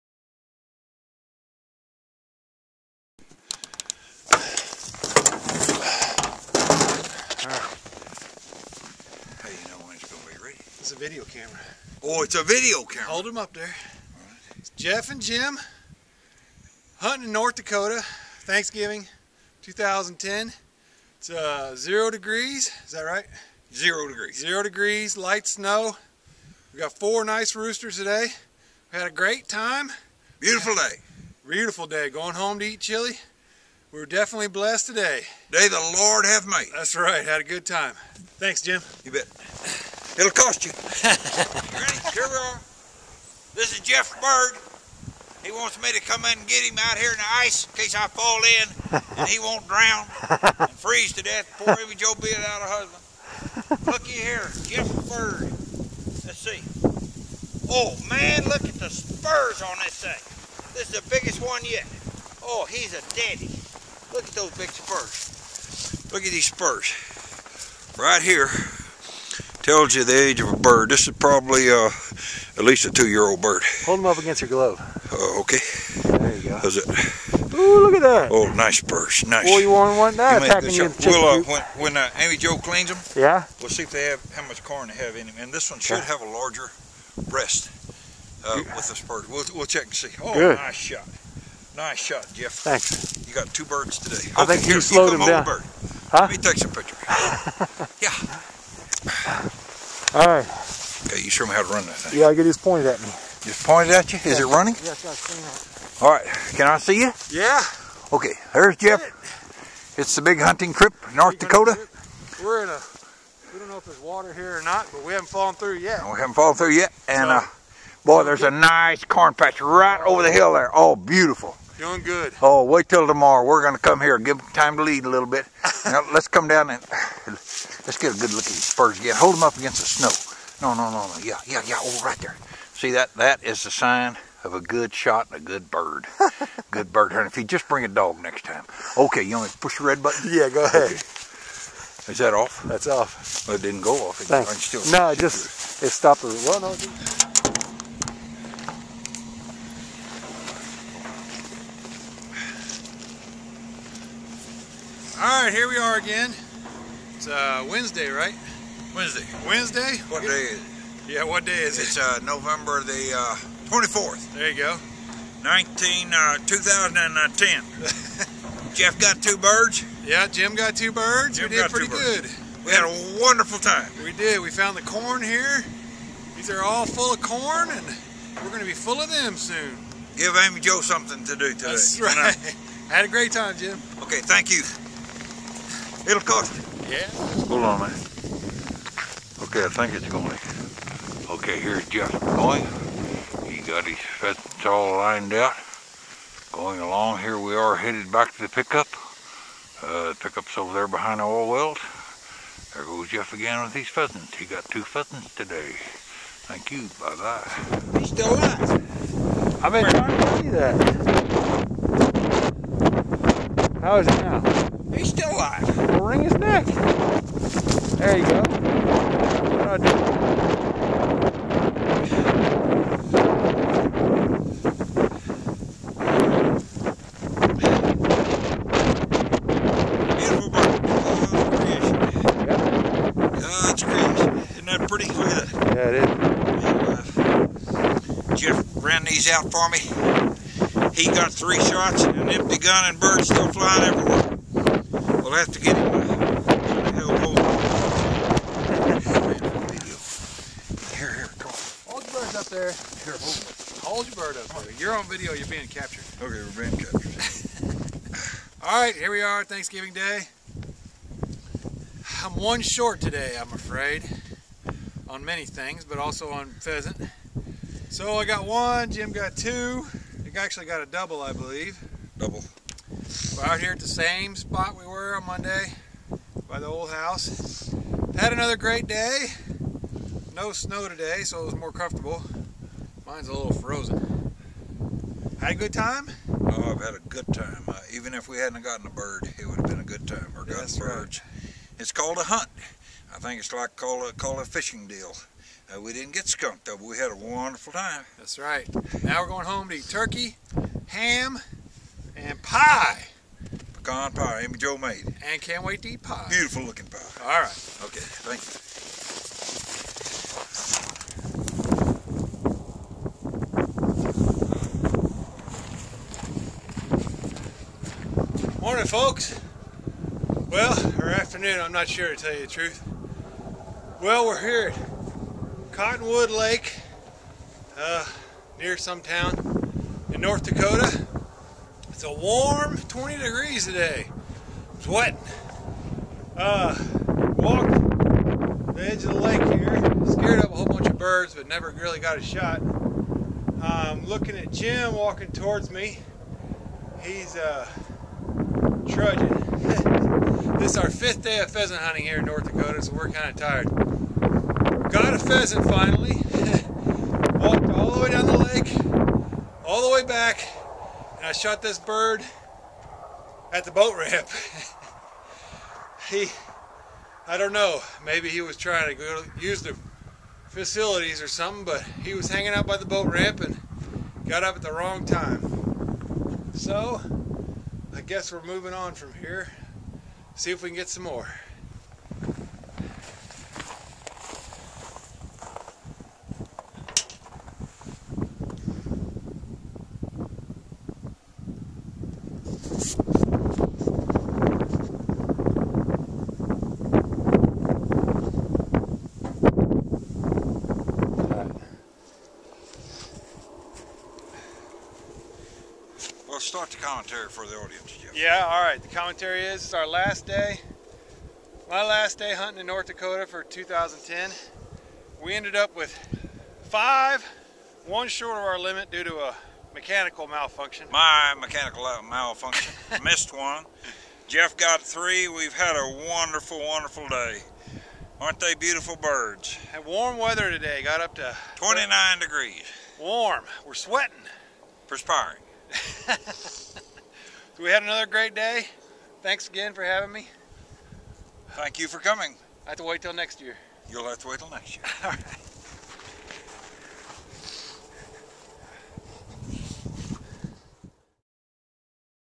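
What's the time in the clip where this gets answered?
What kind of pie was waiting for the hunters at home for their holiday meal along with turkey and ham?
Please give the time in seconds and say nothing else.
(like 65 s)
303 s.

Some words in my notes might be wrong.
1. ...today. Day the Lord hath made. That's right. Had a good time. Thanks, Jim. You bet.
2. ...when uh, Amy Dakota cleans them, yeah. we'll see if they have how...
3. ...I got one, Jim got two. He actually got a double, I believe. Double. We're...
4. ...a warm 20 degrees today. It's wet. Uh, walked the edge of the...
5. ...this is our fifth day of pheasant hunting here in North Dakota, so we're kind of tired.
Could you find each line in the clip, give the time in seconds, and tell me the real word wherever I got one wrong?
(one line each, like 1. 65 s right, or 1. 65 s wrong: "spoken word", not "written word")
1. 34 s right
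2. 81 s wrong: "Joe", not "Dakota"
3. 268 s right
4. 332 s right
5. 350 s right.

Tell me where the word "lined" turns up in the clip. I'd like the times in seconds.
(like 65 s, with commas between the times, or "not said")
194 s.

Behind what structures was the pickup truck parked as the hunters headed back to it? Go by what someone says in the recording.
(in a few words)
Oil wells.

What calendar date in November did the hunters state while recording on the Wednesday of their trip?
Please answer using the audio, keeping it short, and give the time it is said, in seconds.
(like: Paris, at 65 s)
November 24, at 162 s.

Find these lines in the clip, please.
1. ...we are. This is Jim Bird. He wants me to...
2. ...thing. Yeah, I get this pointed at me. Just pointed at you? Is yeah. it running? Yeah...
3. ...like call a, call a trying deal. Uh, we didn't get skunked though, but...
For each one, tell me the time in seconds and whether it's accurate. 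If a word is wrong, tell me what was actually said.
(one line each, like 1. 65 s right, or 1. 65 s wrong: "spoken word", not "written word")
1. 42 s wrong: "Jeff", not "Jim"
2. 101 s right
3. 293 s wrong: "fishing", not "trying".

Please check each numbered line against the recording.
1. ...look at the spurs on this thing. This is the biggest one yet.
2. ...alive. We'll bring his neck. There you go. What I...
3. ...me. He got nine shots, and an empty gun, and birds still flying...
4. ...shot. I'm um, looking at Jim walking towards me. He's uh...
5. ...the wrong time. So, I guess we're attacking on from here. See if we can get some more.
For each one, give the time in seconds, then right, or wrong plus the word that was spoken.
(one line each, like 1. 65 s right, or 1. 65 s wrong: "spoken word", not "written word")
1. 58 s right
2. 215 s wrong: "wring", not "bring"
3. 239 s wrong: "three", not "nine"
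4. 342 s right
5. 374 s wrong: "moving", not "attacking".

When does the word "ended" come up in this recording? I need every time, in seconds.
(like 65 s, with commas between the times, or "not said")
415 s.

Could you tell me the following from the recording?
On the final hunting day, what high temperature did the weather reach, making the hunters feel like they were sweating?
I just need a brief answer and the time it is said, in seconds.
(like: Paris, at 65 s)
29 degrees, at 431 s.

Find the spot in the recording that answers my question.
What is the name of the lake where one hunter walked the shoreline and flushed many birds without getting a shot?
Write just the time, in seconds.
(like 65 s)
325 s.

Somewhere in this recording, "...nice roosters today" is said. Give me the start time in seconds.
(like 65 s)
27 s.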